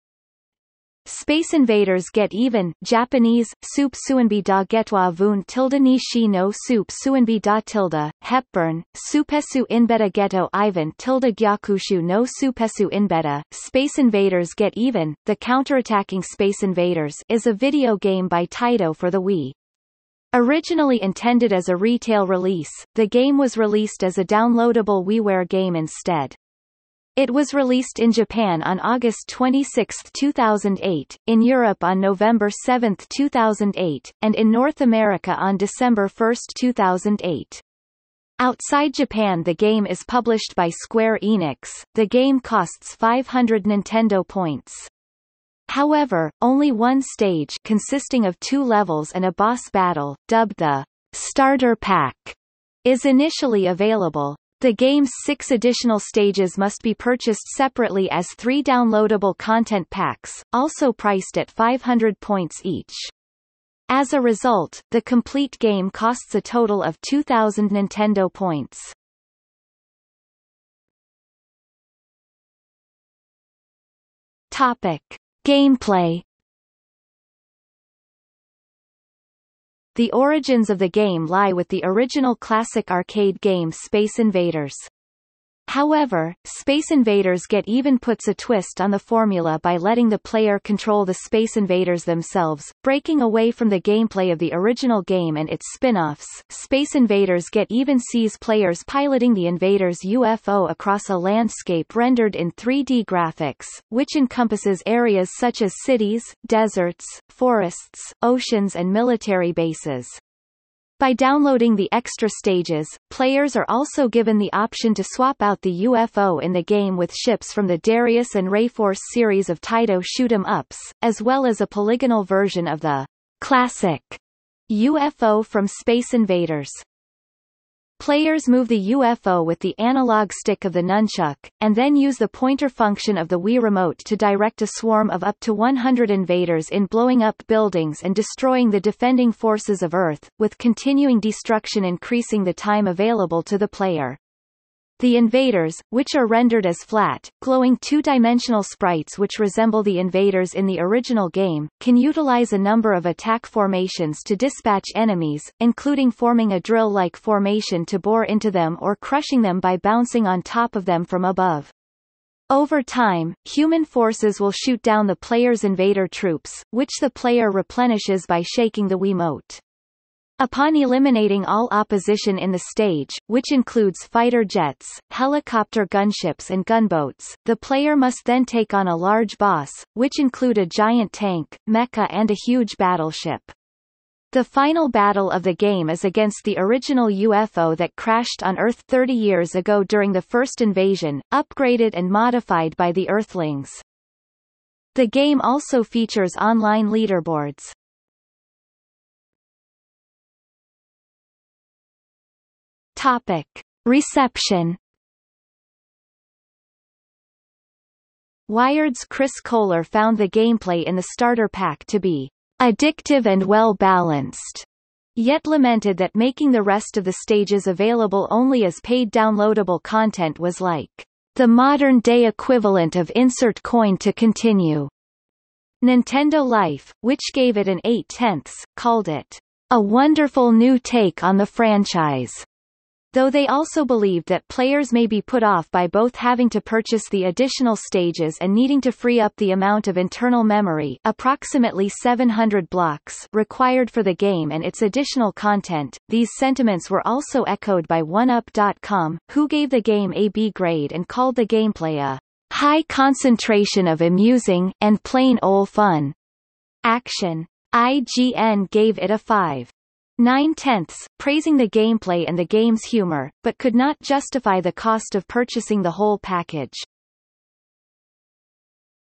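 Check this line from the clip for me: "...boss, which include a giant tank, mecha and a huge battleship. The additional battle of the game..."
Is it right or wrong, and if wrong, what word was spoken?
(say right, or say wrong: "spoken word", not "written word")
wrong: "final", not "additional".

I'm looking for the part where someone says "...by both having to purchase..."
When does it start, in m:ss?
3:55.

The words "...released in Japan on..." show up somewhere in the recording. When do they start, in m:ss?
0:27.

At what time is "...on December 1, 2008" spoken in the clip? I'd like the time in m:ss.
0:35.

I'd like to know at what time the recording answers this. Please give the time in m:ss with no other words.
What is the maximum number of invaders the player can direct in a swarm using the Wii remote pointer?
2:15.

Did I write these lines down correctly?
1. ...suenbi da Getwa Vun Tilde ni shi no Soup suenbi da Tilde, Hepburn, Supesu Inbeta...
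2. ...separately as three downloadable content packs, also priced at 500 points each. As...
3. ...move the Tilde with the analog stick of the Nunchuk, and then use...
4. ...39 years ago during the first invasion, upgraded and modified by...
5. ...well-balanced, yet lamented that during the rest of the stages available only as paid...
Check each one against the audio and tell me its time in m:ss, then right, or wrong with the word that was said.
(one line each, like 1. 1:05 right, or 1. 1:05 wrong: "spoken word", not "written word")
1. 0:03 right
2. 0:57 right
3. 2:08 wrong: "UFO", not "Tilde"
4. 3:08 wrong: "30", not "39"
5. 3:33 wrong: "making", not "during".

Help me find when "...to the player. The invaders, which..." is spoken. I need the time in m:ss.
2:23.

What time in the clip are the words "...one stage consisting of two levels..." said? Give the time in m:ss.
0:46.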